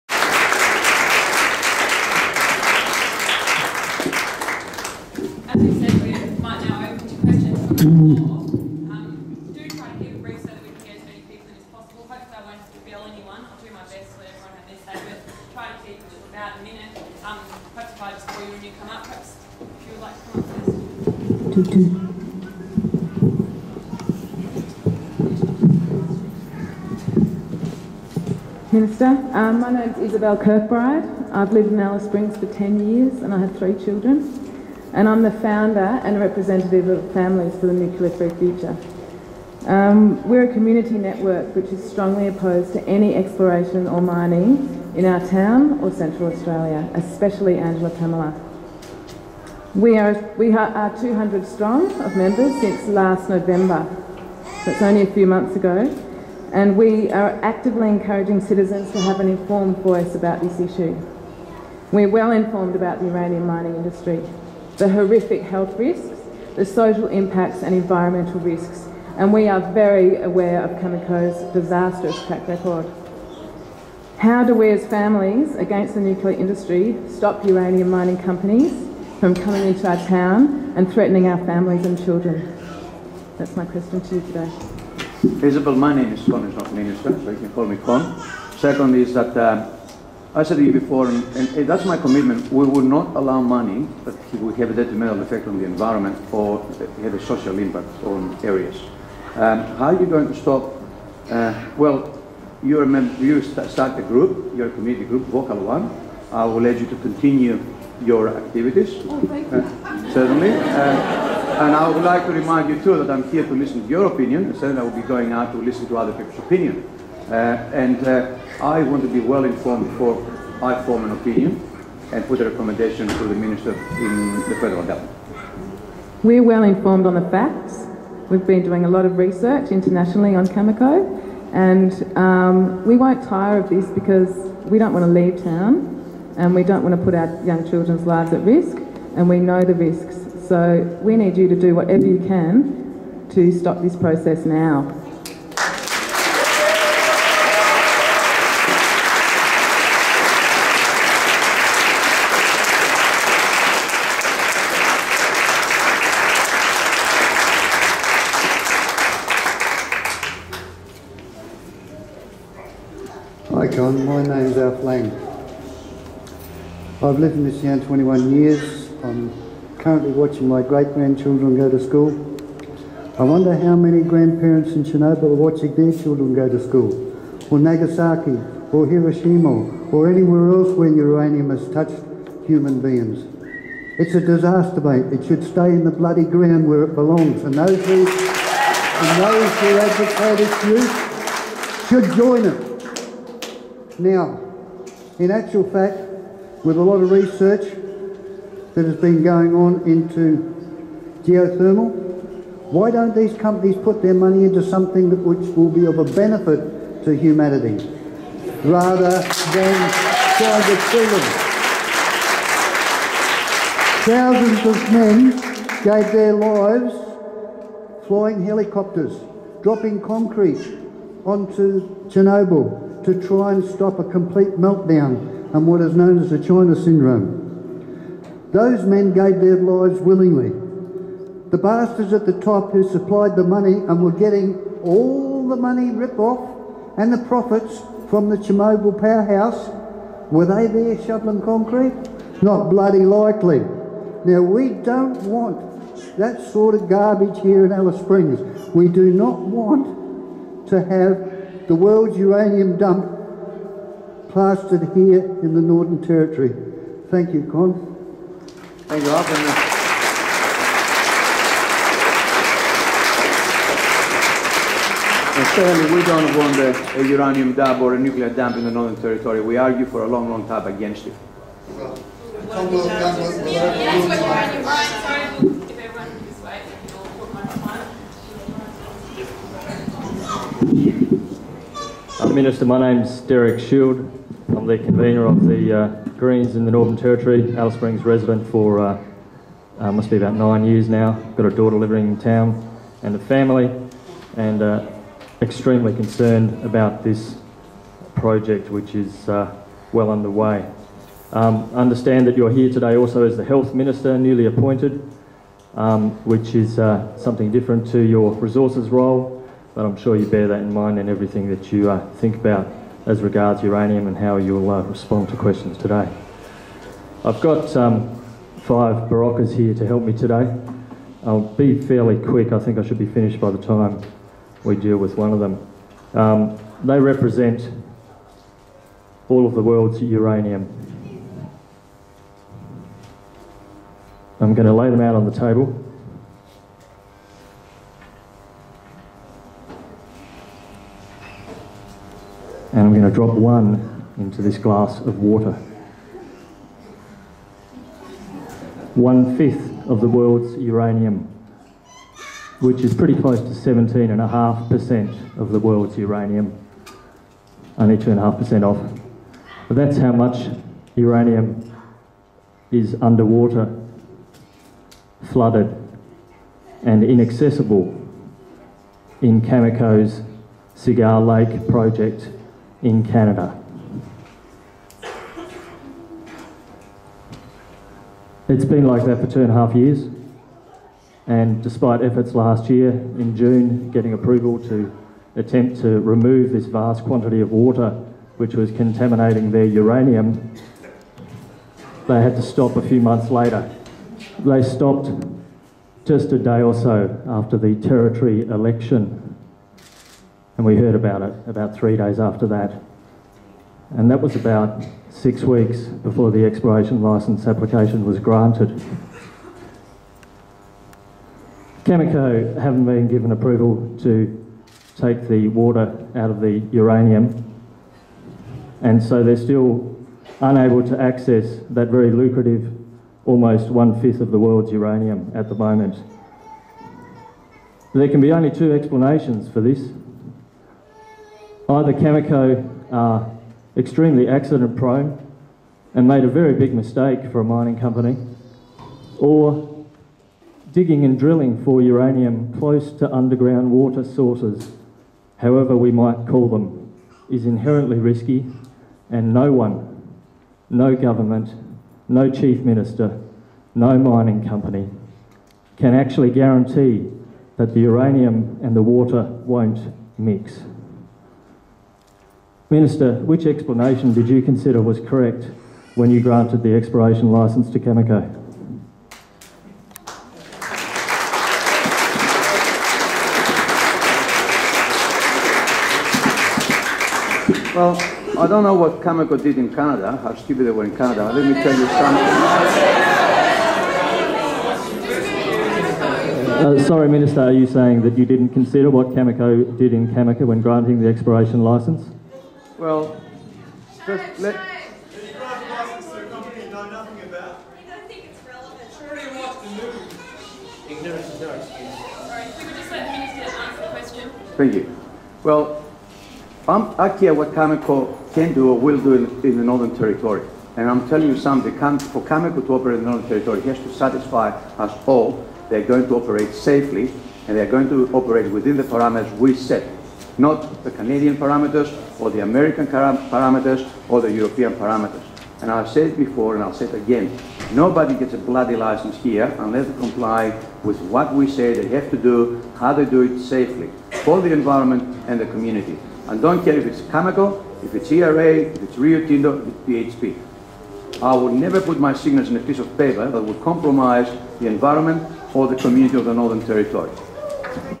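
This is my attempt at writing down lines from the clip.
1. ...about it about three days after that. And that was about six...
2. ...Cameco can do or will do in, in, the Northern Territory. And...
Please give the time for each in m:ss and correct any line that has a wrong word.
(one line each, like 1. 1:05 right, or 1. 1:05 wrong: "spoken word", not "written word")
1. 6:40 right
2. 8:27 right.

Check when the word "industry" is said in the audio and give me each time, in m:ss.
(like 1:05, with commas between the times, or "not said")
1:03, 1:16.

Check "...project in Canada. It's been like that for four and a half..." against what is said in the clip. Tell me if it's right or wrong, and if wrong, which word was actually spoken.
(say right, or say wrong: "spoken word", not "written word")
wrong: "two", not "four".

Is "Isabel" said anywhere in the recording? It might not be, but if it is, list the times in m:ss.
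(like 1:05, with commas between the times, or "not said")
0:30, 1:25.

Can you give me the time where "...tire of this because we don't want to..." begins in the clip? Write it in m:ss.
2:13.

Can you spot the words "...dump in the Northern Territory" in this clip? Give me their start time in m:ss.
4:28.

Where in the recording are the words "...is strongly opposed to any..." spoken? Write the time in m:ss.
0:41.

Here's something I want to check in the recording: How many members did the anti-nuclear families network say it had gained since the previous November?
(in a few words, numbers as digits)
200.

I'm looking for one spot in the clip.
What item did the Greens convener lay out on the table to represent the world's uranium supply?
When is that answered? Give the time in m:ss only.
5:19.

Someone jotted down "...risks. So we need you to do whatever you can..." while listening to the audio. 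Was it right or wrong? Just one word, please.
right.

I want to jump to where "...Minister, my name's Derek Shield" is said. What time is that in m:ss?
4:42.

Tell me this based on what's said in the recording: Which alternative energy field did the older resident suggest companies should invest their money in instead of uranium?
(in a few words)
geothermal.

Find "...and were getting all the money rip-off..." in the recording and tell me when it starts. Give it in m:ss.
3:53.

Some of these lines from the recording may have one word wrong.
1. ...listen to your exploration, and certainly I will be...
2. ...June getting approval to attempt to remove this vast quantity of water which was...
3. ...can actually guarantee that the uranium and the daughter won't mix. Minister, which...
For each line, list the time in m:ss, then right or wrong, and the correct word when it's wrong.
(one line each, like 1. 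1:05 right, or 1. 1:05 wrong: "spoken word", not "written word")
1. 1:53 wrong: "opinion", not "exploration"
2. 6:23 right
3. 7:35 wrong: "water", not "daughter".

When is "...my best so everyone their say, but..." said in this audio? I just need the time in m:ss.
0:13.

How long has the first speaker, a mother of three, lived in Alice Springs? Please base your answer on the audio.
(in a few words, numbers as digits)
10 years.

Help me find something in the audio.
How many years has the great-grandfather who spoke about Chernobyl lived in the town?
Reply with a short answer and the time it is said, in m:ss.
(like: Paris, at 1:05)
21 years, at 2:47.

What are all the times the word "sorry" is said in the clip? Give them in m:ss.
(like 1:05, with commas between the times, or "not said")
8:06, 8:21.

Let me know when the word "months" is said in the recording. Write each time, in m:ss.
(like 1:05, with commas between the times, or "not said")
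0:55, 6:32.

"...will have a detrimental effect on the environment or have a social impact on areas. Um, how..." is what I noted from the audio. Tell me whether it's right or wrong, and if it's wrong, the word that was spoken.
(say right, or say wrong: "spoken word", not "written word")
right.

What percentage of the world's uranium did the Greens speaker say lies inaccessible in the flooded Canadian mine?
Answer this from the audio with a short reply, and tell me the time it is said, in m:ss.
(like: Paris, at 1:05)
17.5%, at 5:53.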